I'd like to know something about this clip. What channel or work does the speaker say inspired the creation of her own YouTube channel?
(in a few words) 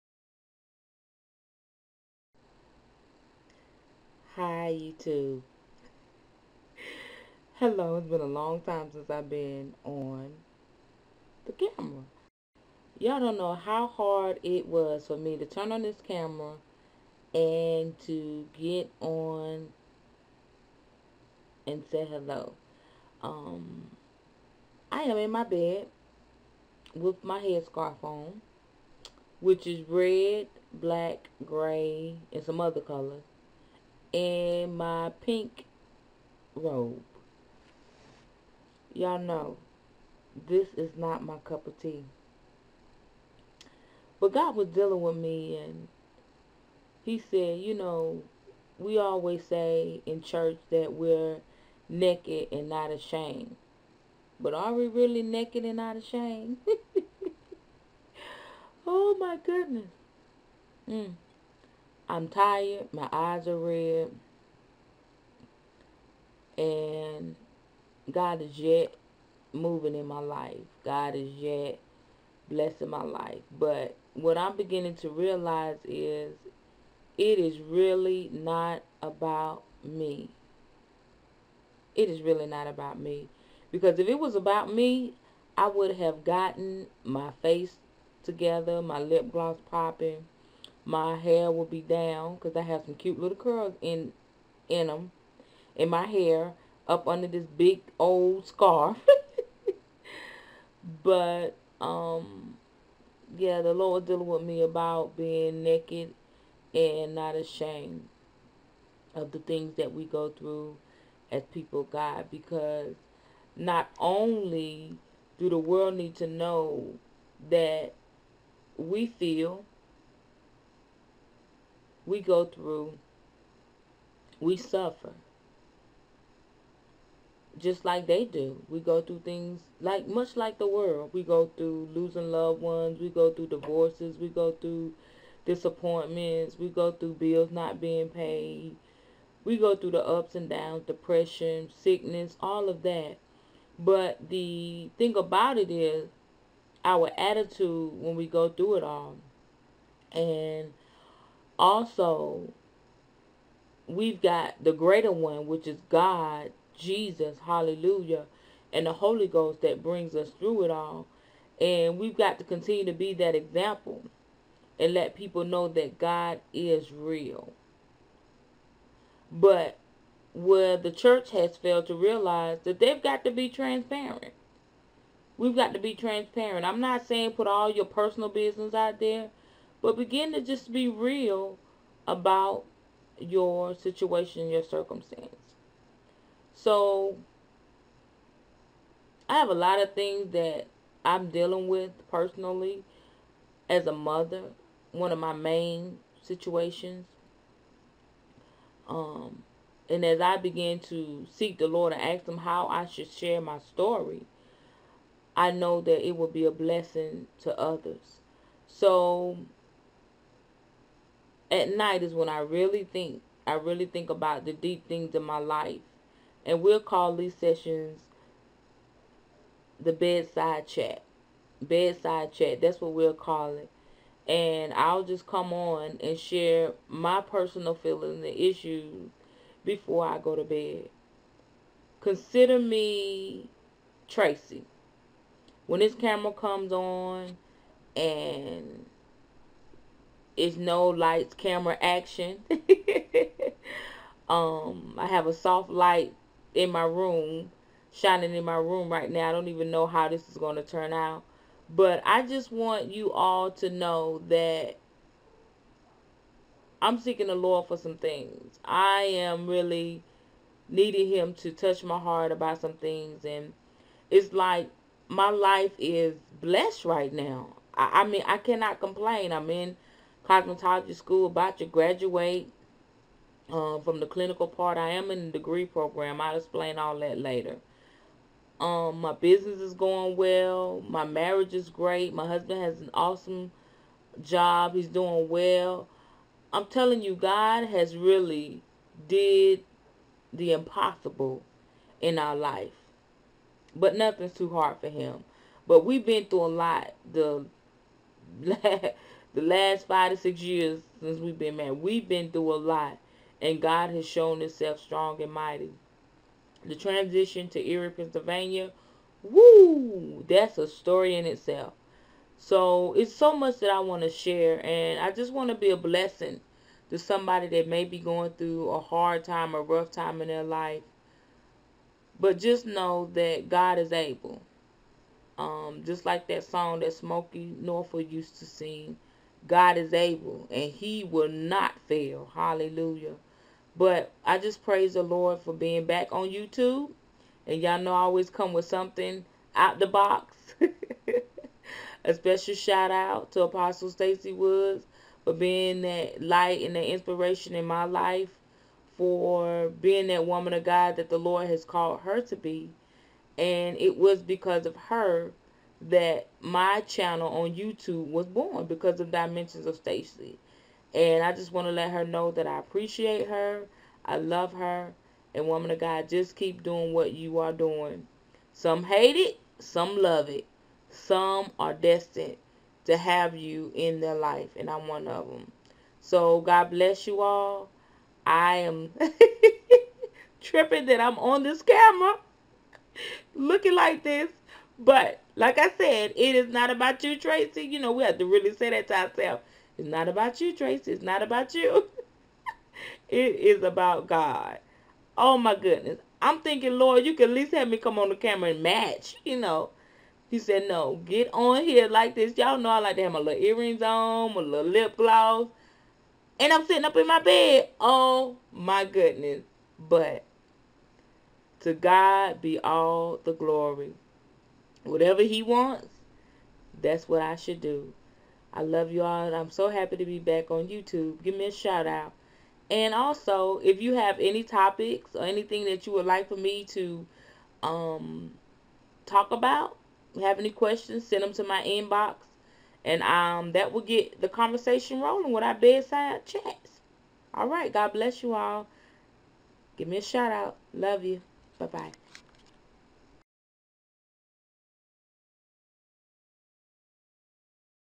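Dimensions of Stacy.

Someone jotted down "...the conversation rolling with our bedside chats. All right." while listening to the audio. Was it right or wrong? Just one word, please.
right.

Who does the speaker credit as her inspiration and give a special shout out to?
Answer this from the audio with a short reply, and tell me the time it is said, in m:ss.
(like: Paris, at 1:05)
Apostle Stacy Woods, at 5:43.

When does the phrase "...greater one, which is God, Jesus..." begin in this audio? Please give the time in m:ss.
2:34.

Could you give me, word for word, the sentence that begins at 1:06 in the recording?
And God is yet moving in my life.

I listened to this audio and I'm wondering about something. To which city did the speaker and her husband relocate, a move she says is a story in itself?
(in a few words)
Erie, Pennsylvania.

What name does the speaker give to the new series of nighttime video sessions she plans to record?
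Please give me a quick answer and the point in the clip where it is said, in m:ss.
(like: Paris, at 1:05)
Bedside chat, at 3:39.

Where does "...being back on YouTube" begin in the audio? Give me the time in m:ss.
5:35.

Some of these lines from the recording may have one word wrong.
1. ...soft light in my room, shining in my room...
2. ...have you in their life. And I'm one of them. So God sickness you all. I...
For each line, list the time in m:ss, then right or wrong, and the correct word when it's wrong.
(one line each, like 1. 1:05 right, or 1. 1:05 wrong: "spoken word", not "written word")
1. 4:05 right
2. 6:12 wrong: "bless", not "sickness".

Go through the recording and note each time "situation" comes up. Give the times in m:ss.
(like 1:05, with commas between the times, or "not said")
3:03, 3:16.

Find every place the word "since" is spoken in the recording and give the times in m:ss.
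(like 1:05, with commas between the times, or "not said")
0:08, 5:01.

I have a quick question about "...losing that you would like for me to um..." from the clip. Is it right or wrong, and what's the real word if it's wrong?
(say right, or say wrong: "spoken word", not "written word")
wrong: "anything", not "losing".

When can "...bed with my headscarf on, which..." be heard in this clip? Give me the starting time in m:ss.
0:25.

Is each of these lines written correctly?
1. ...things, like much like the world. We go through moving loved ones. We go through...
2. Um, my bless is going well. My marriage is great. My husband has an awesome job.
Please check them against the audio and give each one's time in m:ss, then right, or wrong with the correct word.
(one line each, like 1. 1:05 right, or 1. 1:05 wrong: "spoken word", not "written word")
1. 2:09 wrong: "losing", not "moving"
2. 4:38 wrong: "business", not "bless".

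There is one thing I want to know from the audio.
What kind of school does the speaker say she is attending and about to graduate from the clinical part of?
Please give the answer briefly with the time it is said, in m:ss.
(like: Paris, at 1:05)
Cosmetology school, at 4:30.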